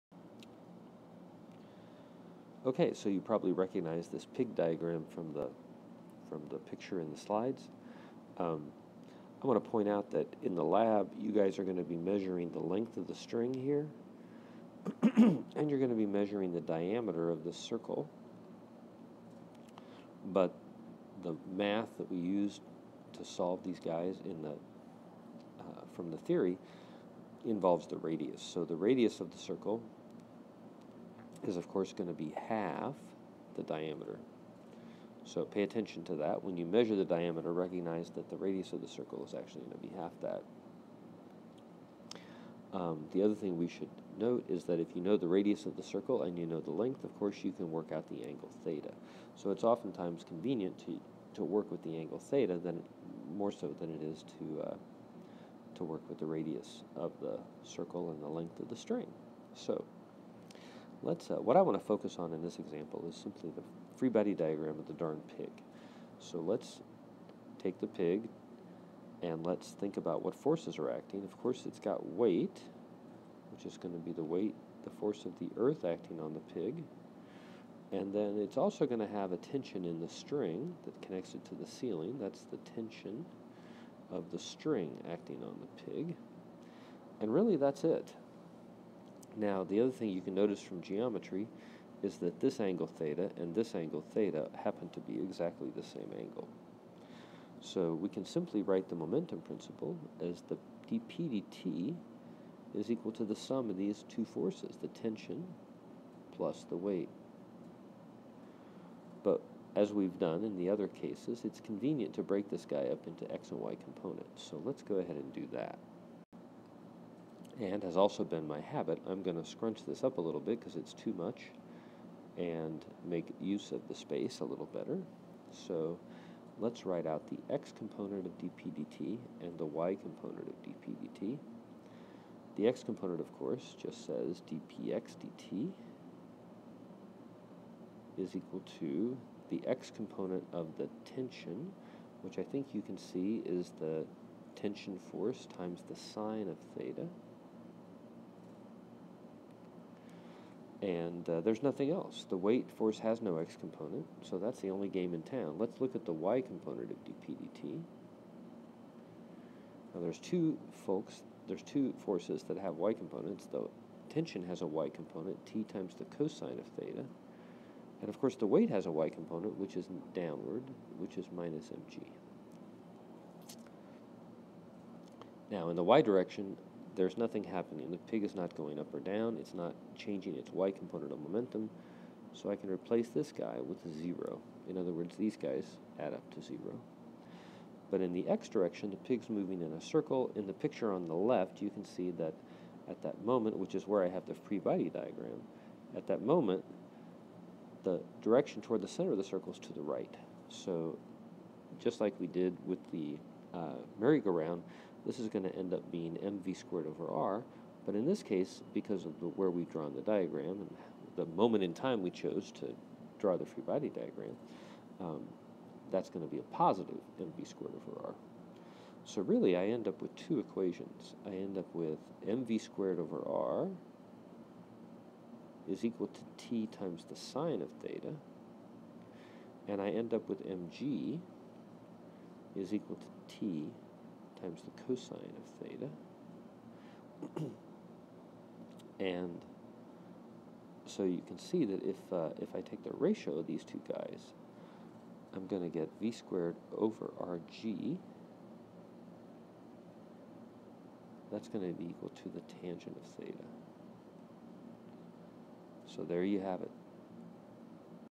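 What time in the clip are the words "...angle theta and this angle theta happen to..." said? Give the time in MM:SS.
01:32.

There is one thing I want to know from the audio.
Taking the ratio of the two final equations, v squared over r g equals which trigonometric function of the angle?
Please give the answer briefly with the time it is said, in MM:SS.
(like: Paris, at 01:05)
tangent of theta, at 04:12.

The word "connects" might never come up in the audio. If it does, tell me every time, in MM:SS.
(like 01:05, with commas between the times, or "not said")
01:21.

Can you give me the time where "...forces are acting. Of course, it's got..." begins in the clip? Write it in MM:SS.
01:10.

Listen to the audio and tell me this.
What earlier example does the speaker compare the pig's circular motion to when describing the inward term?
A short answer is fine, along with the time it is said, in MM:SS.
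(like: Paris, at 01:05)
merry-go-round, at 03:23.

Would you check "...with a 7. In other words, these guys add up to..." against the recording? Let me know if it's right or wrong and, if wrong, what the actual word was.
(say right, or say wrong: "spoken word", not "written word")
wrong: "0", not "7".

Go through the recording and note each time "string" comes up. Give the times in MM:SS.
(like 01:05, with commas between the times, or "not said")
00:13, 00:58, 01:20, 01:24.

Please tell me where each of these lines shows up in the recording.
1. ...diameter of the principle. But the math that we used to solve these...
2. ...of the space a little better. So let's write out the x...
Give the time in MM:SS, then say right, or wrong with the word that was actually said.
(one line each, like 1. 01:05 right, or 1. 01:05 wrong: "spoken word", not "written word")
1. 00:16 wrong: "circle", not "principle"
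2. 02:03 right.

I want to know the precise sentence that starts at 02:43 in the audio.
The tension has a y component, t times the cosine of theta.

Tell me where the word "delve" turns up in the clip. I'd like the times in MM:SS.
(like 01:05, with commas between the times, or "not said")
not said.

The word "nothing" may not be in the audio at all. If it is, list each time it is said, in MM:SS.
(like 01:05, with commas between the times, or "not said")
02:31, 02:57.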